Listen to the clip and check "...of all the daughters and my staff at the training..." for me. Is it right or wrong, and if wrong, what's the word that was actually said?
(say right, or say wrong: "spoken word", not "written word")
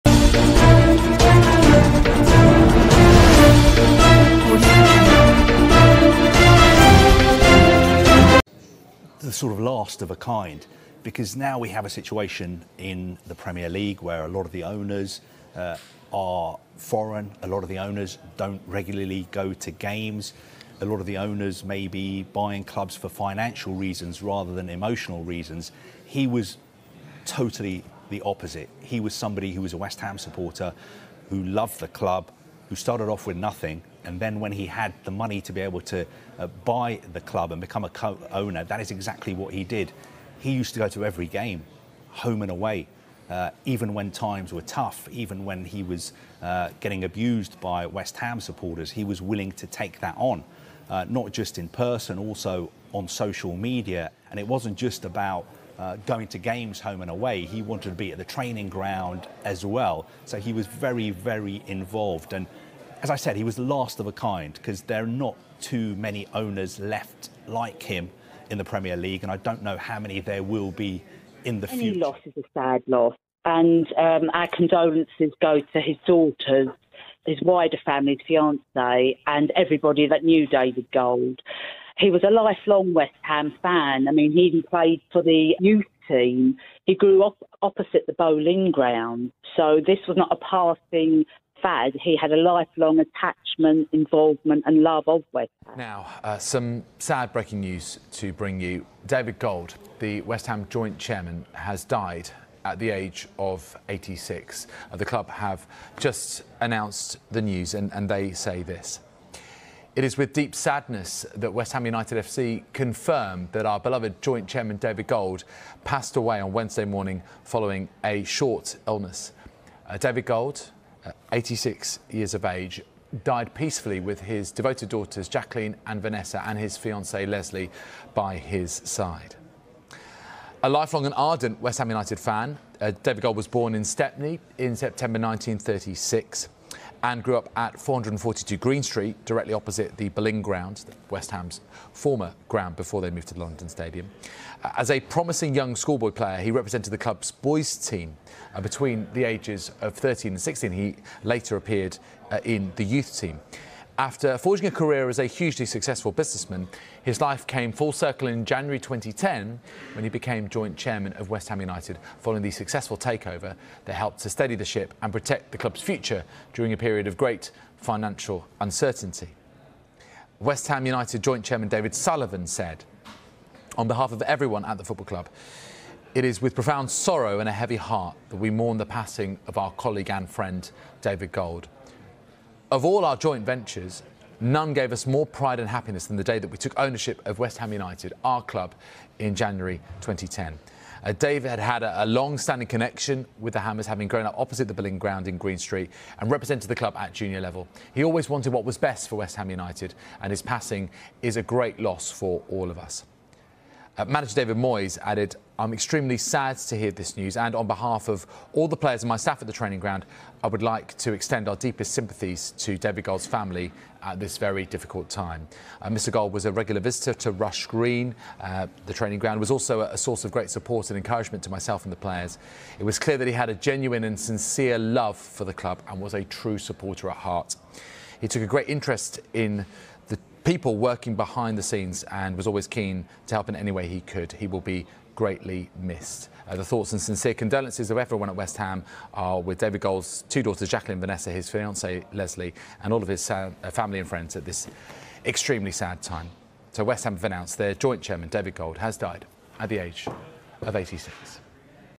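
wrong: "players", not "daughters".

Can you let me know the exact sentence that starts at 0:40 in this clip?
He used to go to every game, home and away.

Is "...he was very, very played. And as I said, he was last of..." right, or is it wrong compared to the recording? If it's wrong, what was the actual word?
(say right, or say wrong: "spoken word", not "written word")
wrong: "involved", not "played".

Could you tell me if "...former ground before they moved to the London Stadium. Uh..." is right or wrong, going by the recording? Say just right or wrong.
right.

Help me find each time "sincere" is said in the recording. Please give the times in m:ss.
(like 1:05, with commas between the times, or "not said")
3:44, 3:57.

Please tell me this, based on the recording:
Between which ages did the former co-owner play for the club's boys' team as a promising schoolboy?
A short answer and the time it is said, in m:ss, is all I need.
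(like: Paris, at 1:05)
13 and 16, at 2:29.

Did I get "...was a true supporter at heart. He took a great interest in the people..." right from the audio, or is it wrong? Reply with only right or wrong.
right.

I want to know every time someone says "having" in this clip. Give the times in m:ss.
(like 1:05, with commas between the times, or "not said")
3:13.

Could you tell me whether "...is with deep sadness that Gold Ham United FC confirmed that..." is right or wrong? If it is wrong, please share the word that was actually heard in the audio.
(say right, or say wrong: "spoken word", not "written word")
wrong: "West", not "Gold".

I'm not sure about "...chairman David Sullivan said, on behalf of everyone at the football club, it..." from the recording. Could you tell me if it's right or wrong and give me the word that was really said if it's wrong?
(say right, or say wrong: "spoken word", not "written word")
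right.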